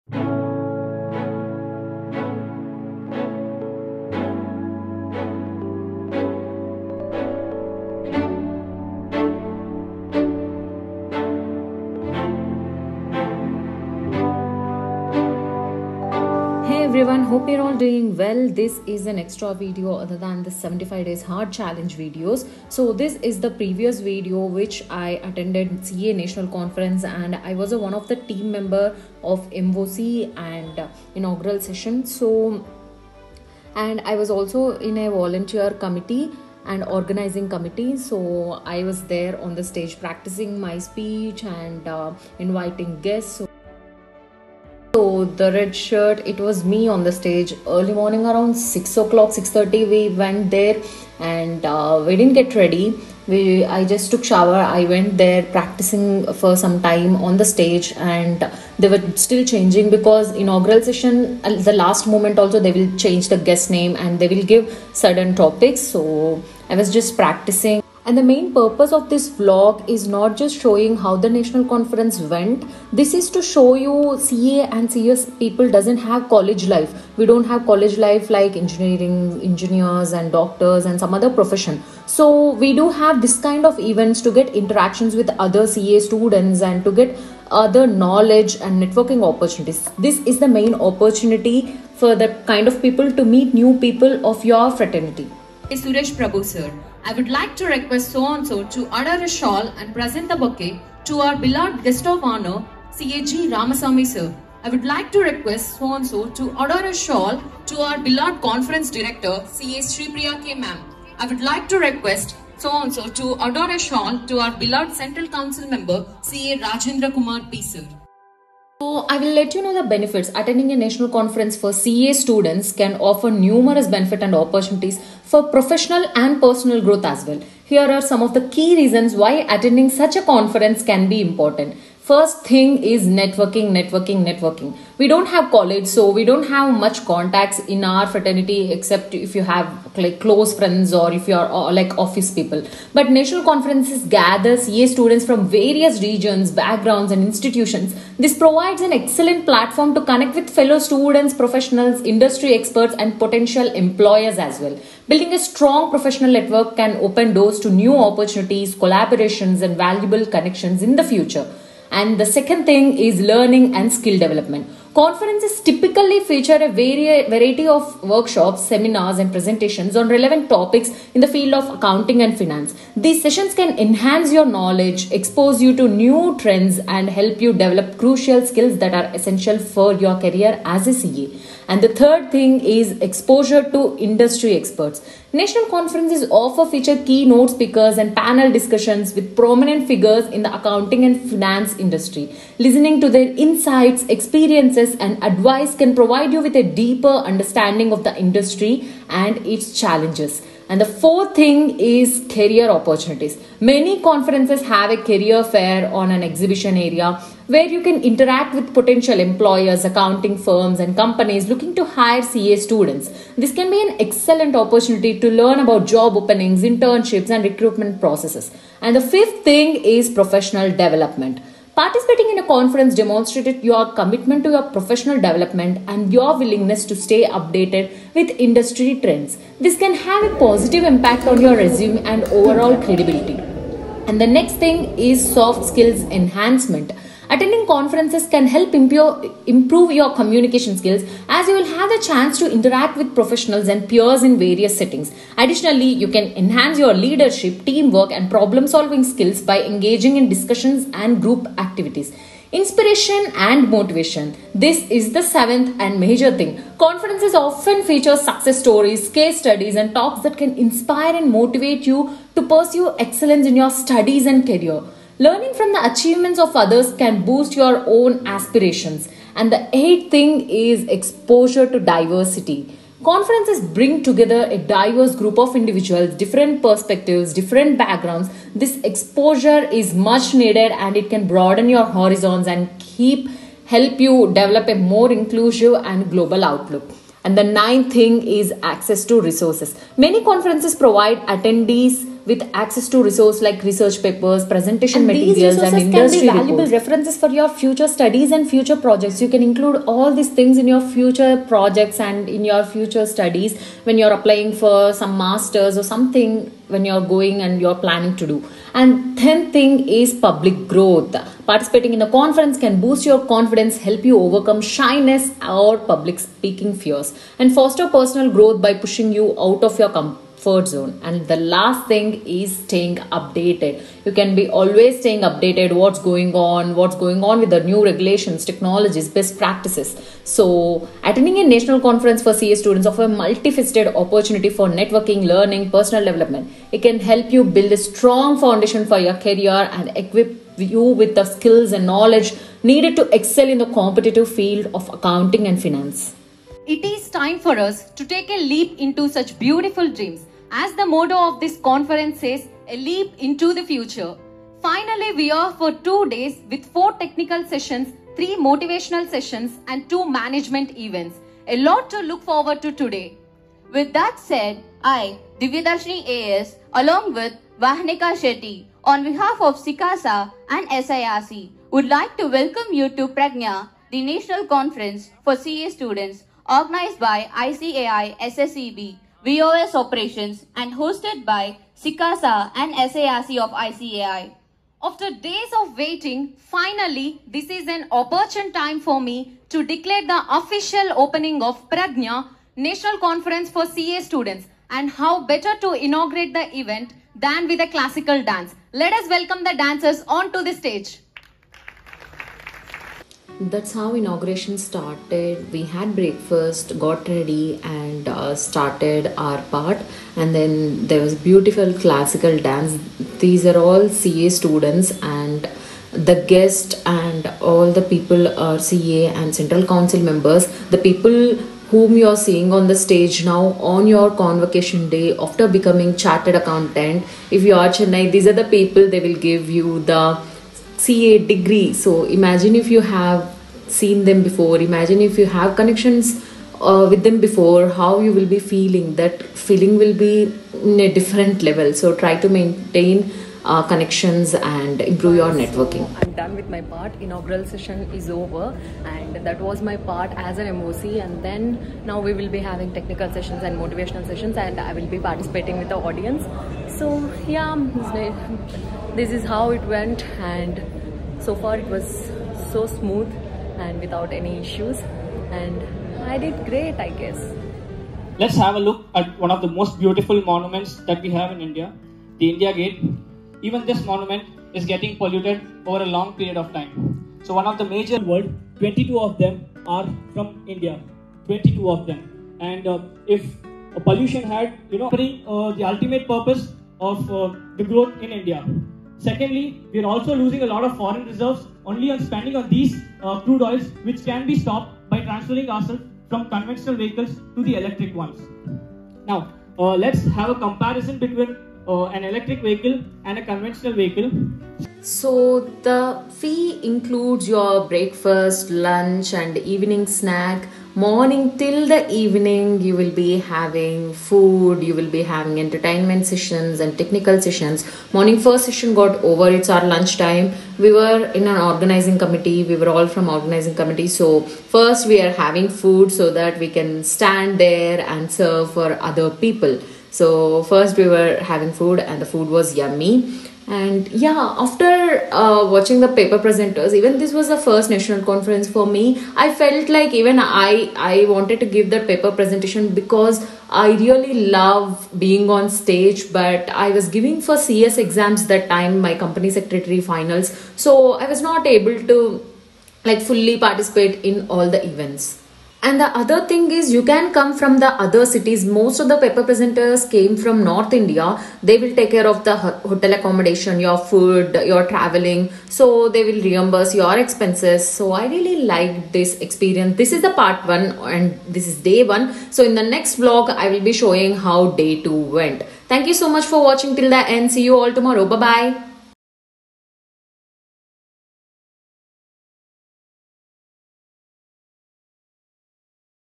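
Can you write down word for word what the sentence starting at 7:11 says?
So imagine if you have seen them before, imagine if you have connections uh, with them before, how you will be feeling.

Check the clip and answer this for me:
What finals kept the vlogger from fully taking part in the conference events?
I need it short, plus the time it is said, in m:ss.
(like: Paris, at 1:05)
Company secretary finals, at 9:08.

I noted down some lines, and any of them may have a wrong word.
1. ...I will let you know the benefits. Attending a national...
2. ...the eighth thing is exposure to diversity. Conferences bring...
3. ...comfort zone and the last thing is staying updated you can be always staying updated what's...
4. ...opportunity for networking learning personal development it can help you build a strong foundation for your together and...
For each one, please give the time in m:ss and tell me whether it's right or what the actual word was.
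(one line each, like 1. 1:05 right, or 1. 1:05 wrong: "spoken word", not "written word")
1. 1:59 right
2. 4:29 right
3. 5:20 right
4. 5:34 wrong: "career", not "together".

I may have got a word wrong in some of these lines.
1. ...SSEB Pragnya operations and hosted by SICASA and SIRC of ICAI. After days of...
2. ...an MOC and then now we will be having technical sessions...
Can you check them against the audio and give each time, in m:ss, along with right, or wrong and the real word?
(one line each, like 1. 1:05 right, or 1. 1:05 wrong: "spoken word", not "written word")
1. 6:18 wrong: "BOS", not "Pragnya"
2. 7:30 right.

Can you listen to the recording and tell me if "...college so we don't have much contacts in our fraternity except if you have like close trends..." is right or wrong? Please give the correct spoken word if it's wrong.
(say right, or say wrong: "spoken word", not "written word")
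wrong: "friends", not "trends".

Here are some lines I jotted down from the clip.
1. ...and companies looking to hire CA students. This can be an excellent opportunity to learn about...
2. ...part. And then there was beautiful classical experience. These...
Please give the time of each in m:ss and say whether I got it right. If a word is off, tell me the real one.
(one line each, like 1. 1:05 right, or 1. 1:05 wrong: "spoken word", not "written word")
1. 3:30 right
2. 6:49 wrong: "dance", not "experience".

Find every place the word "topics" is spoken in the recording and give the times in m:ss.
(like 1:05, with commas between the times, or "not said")
1:05, 2:50.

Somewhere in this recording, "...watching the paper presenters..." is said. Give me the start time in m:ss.
8:55.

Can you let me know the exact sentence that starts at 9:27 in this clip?
So I really like this experience.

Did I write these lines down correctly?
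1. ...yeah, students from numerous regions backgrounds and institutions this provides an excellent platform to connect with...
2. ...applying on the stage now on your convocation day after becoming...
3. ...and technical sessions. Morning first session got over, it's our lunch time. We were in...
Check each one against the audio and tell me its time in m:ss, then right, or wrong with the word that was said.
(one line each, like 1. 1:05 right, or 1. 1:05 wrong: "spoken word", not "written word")
1. 2:24 wrong: "various", not "numerous"
2. 7:02 wrong: "seeing", not "applying"
3. 8:36 right.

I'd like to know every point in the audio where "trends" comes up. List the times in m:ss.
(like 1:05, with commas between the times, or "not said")
2:56, 3:49.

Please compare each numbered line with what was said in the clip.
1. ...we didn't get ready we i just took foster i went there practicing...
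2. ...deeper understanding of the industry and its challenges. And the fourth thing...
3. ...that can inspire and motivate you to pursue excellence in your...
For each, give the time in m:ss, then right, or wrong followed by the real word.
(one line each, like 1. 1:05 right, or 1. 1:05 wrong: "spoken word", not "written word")
1. 0:52 wrong: "shower", not "foster"
2. 3:16 right
3. 4:20 right.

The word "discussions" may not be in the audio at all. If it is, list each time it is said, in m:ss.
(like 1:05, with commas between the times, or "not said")
3:08, 4:10.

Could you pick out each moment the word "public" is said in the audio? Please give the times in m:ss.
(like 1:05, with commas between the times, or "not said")
5:10, 5:15.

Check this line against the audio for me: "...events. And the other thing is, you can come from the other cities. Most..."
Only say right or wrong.
right.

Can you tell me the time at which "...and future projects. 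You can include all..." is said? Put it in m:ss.
4:58.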